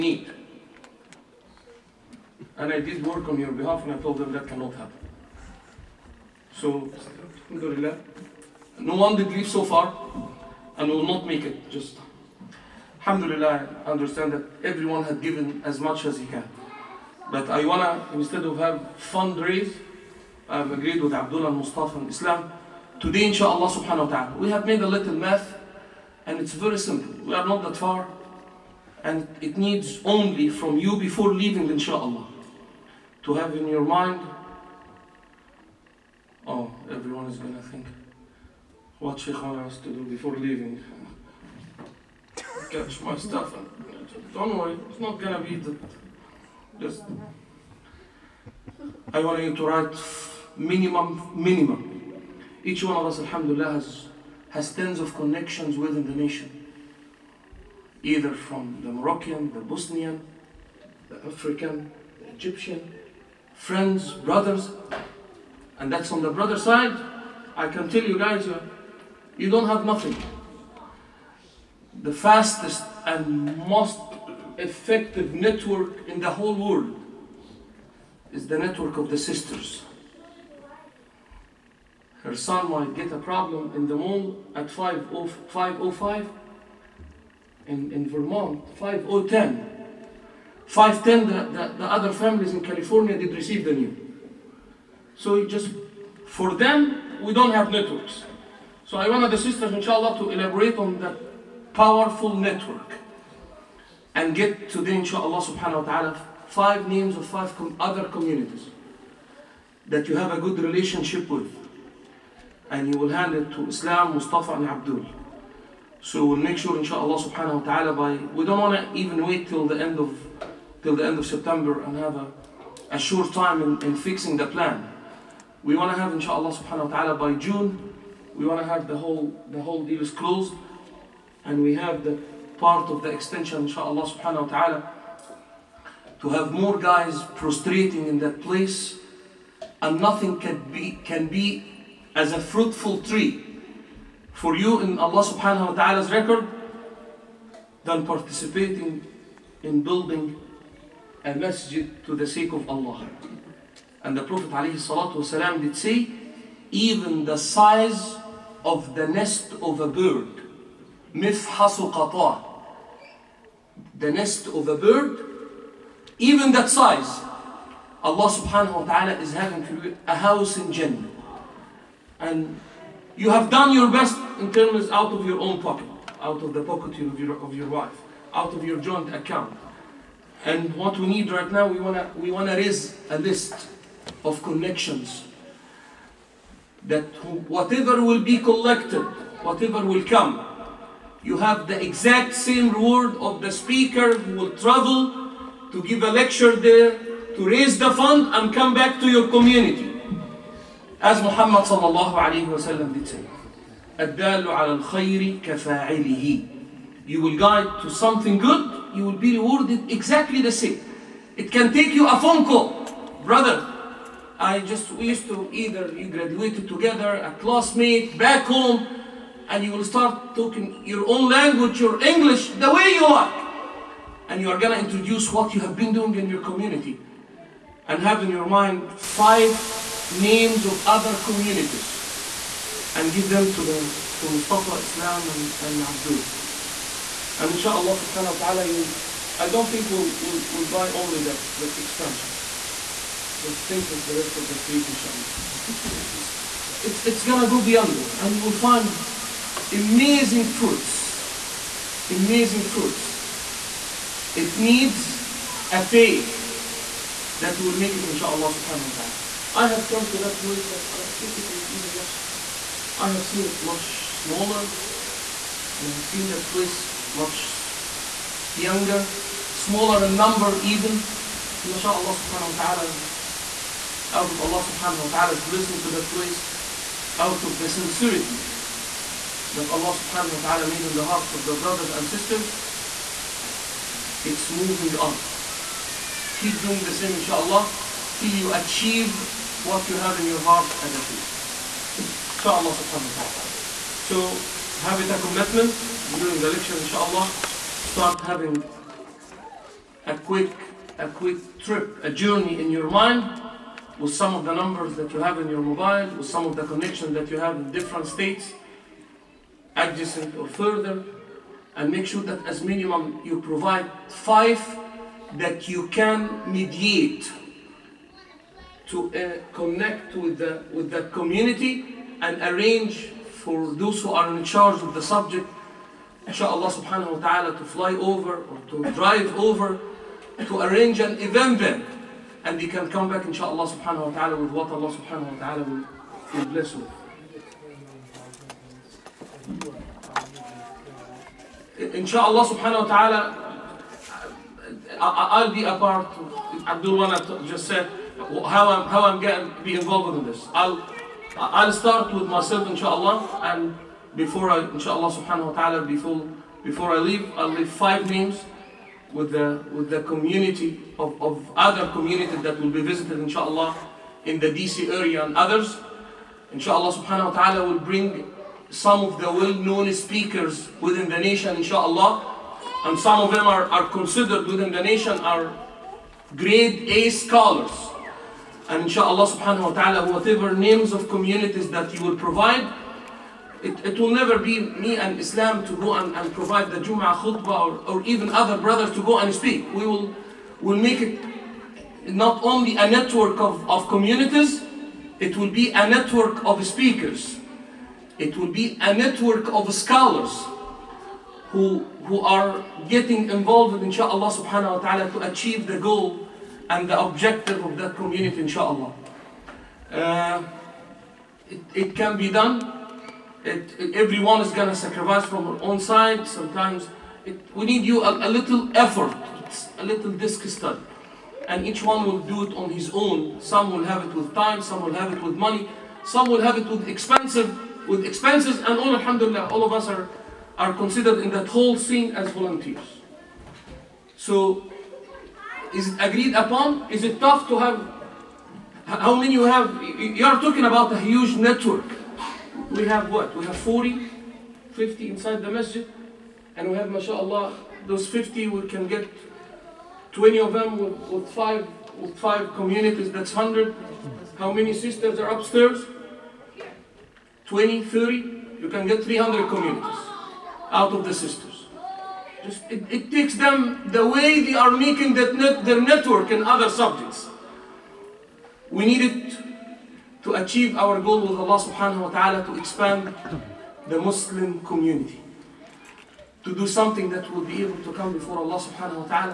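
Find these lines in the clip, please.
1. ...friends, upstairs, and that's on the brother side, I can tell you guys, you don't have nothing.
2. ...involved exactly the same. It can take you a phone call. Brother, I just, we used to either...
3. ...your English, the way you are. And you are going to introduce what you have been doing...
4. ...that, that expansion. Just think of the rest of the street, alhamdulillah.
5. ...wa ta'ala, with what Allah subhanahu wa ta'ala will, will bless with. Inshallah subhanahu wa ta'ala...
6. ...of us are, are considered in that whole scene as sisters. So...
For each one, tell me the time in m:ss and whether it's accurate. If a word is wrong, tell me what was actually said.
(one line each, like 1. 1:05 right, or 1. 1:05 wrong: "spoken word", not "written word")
1. 1:03 wrong: "brothers", not "upstairs"
2. 3:29 wrong: "rewarded", not "involved"
3. 3:41 right
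4. 4:01 wrong: "inshallah", not "alhamdulillah"
5. 5:34 right
6. 7:09 wrong: "volunteers", not "sisters".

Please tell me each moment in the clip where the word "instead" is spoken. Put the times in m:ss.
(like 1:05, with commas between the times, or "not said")
0:18.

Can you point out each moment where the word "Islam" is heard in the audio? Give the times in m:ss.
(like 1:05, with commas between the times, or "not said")
0:22, 1:53, 3:54, 6:25.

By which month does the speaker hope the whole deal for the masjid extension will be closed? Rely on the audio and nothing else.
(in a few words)
June.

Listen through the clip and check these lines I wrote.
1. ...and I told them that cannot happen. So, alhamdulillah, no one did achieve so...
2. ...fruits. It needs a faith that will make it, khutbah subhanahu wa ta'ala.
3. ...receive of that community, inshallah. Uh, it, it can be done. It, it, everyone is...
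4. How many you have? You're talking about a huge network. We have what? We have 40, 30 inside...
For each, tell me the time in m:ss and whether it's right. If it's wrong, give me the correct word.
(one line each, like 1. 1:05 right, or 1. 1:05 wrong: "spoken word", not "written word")
1. 0:03 wrong: "leave", not "achieve"
2. 4:12 wrong: "inshallah", not "khutbah"
3. 6:46 wrong: "objective", not "receive"
4. 7:18 wrong: "50", not "30".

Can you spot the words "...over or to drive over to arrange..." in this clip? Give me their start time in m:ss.
5:27.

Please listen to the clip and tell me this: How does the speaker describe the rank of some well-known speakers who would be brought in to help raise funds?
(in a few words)
grade A scholars.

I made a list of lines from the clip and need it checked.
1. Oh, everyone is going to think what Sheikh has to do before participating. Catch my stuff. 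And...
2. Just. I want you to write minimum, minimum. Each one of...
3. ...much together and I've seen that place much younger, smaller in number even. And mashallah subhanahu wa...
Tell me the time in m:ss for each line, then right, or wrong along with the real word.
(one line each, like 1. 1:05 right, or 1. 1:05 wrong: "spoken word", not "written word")
1. 0:36 wrong: "leaving", not "participating"
2. 0:46 right
3. 4:23 wrong: "smaller", not "together".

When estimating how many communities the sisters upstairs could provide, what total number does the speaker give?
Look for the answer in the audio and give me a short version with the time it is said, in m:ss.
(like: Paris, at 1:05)
300, at 7:39.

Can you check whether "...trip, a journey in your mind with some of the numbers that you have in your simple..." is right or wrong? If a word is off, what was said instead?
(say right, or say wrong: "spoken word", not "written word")
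wrong: "mobile", not "simple".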